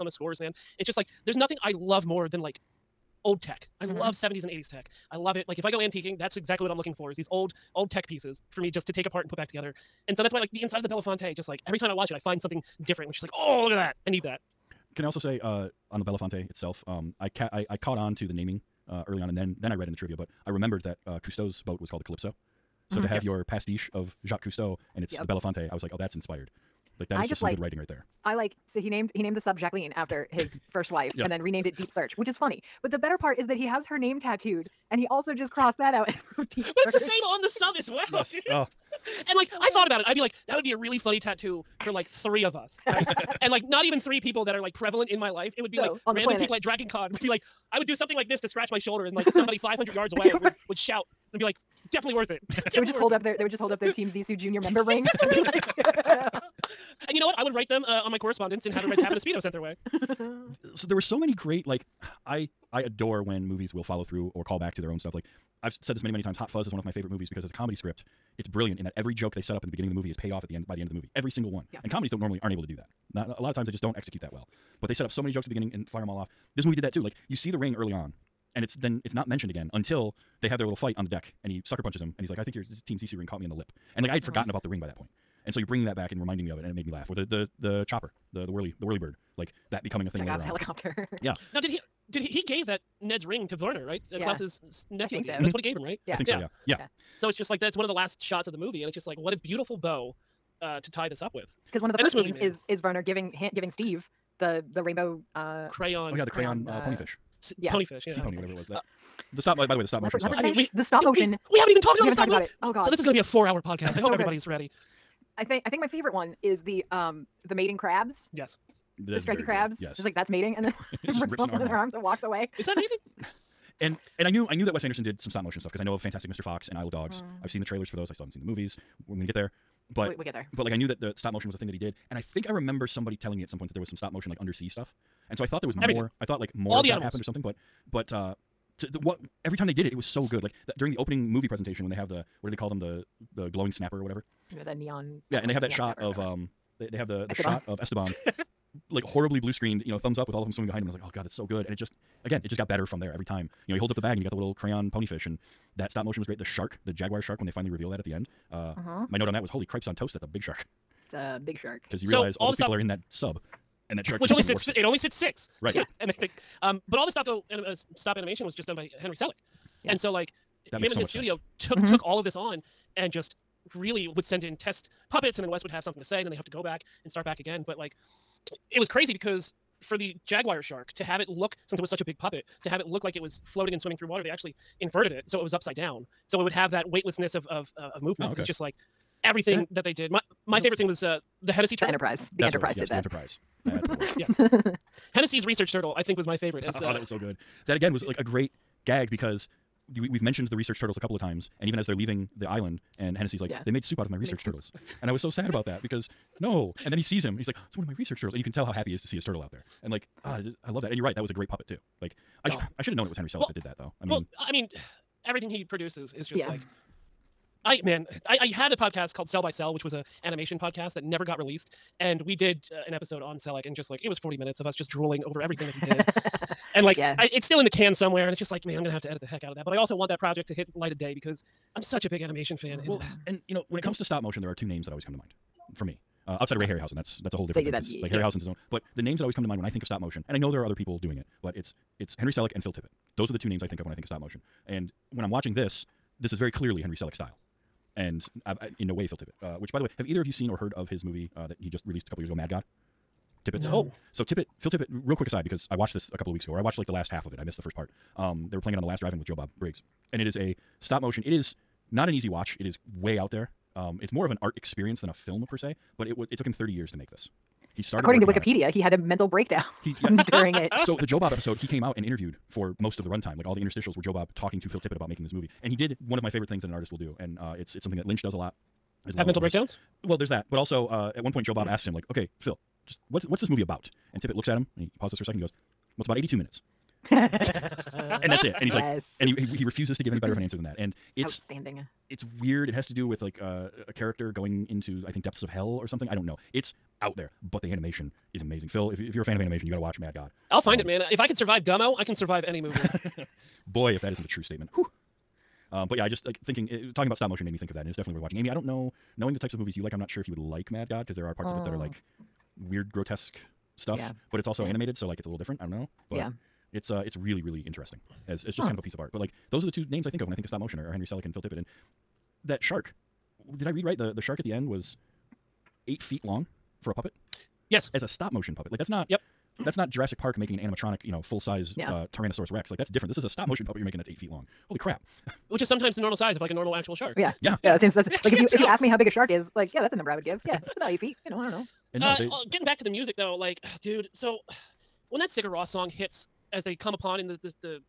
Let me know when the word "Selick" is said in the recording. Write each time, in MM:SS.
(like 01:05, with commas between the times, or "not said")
02:49, 03:33, 03:43, 04:02, 04:06, 05:21.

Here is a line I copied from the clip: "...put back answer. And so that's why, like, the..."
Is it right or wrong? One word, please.
wrong.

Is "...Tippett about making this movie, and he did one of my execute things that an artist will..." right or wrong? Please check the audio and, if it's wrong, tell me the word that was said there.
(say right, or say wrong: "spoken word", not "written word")
wrong: "favorite", not "execute".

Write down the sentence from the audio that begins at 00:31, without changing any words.
and then renamed it Deep Search, which is funny.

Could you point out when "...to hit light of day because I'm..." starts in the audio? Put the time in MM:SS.
03:50.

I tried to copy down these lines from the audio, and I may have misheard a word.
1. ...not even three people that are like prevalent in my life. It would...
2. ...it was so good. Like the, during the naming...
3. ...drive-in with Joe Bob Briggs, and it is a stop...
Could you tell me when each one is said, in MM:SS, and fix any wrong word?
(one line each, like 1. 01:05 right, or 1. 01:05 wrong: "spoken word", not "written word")
1. 00:43 right
2. 02:19 wrong: "opening", not "naming"
3. 04:18 right.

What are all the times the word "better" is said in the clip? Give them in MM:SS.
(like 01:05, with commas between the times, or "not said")
00:32, 02:32, 04:50.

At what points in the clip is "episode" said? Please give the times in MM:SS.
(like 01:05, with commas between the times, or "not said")
03:42, 04:31.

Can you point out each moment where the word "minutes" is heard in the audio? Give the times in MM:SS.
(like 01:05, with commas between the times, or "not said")
03:44, 04:46.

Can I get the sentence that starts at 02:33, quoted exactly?
You know, he holds up the bag, and you got the little crayon ponyfish, and that stop motion was great.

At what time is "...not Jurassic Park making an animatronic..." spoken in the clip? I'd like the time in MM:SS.
05:29.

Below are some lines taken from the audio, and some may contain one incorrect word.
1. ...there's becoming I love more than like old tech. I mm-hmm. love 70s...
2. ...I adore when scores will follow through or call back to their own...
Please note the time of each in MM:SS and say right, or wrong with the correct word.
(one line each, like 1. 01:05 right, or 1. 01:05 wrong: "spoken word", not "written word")
1. 00:01 wrong: "nothing", not "becoming"
2. 01:02 wrong: "movies", not "scores".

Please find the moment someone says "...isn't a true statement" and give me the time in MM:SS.
05:04.